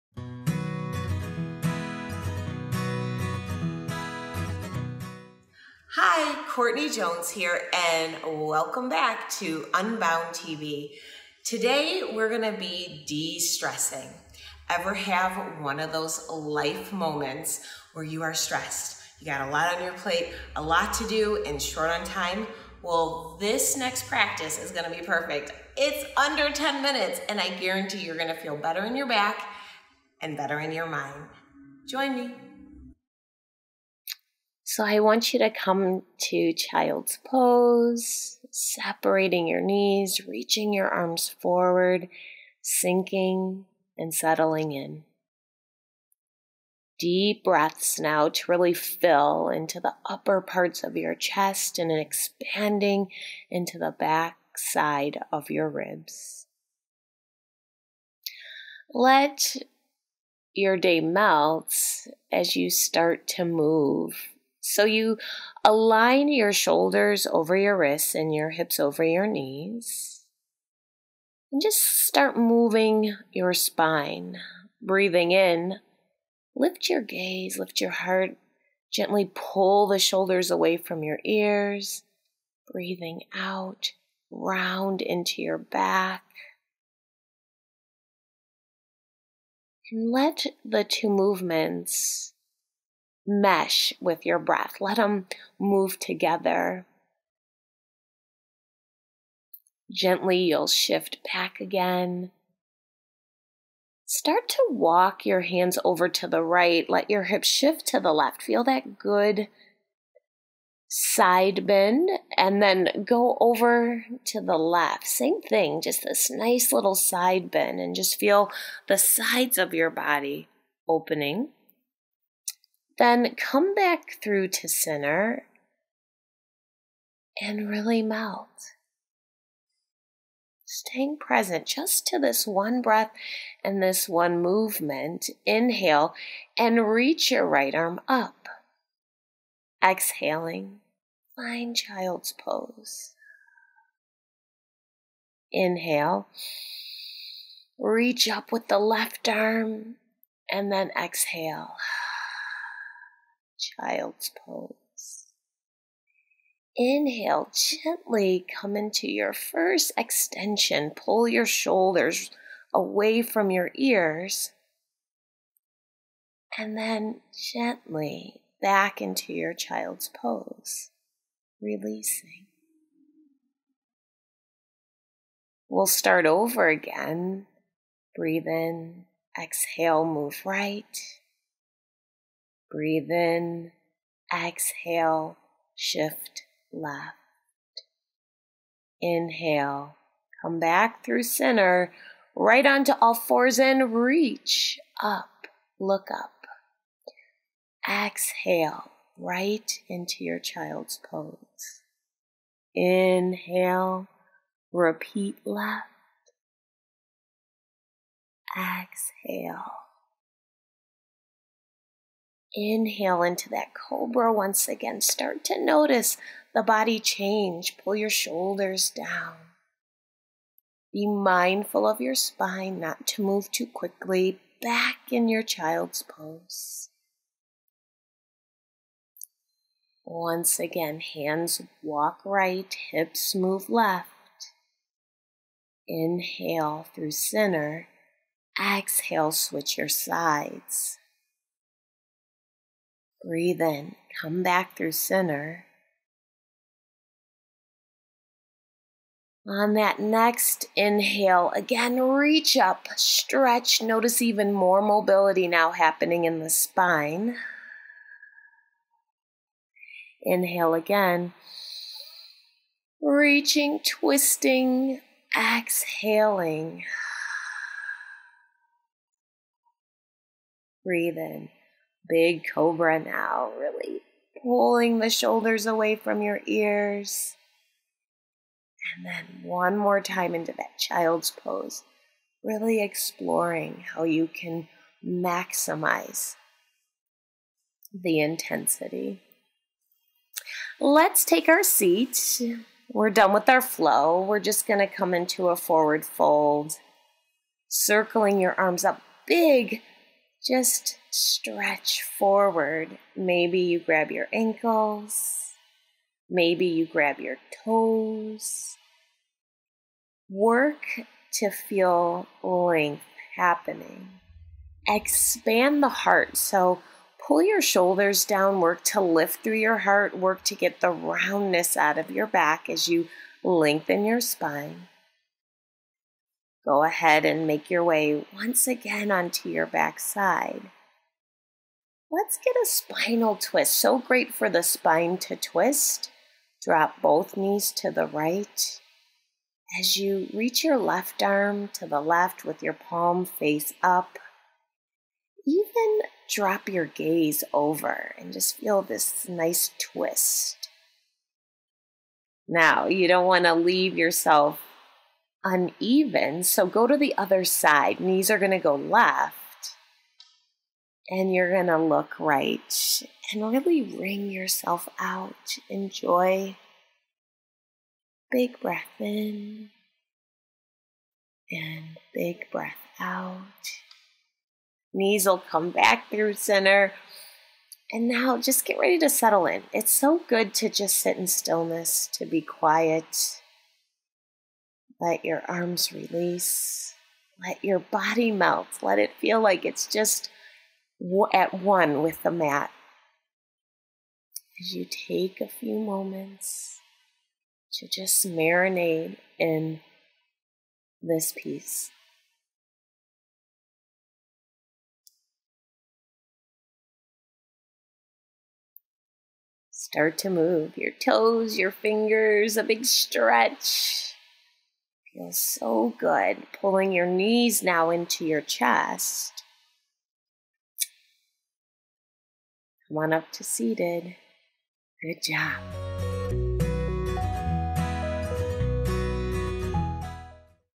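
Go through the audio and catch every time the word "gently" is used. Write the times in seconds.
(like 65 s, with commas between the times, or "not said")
78 s, 99 s, 157 s, 167 s.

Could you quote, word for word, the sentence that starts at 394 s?
As you take a few moments to just marinate in this peace.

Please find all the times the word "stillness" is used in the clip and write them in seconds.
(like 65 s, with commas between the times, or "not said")
381 s.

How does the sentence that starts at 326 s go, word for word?
Go ahead and make your way once again onto your backside.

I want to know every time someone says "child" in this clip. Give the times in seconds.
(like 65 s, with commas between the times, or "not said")
36 s, 141 s, 153 s, 169 s, 200 s, 225 s, 280 s.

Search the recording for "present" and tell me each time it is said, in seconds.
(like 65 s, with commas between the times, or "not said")
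131 s.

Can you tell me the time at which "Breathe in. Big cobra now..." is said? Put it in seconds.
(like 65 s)
270 s.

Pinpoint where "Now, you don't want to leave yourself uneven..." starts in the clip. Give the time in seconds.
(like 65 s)
352 s.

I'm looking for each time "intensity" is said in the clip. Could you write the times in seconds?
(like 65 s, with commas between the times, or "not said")
288 s.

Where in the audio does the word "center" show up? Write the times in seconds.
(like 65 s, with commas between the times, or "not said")
124 s, 191 s, 237 s, 244 s, 376 s.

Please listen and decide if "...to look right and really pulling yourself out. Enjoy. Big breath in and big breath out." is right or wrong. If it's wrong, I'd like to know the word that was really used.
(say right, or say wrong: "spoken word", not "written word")
wrong: "wring", not "pulling".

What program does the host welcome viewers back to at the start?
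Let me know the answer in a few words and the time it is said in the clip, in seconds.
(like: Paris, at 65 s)
Unbound TV, at 9 s.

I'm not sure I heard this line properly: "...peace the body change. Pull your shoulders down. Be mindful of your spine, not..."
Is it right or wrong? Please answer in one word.
wrong.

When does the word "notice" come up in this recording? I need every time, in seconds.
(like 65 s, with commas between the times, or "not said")
215 s, 253 s.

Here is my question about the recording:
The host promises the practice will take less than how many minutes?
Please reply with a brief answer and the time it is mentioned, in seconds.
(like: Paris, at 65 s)
10, at 26 s.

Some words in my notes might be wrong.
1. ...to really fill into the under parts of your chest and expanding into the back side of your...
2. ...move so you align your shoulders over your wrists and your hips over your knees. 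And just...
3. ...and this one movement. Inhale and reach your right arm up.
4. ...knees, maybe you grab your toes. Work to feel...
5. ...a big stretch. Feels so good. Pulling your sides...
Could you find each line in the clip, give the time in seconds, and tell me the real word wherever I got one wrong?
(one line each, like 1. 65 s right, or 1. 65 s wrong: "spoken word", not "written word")
1. 48 s wrong: "upper", not "under"
2. 63 s right
3. 133 s right
4. 304 s wrong: "ankles", not "knees"
5. 412 s wrong: "knees", not "sides".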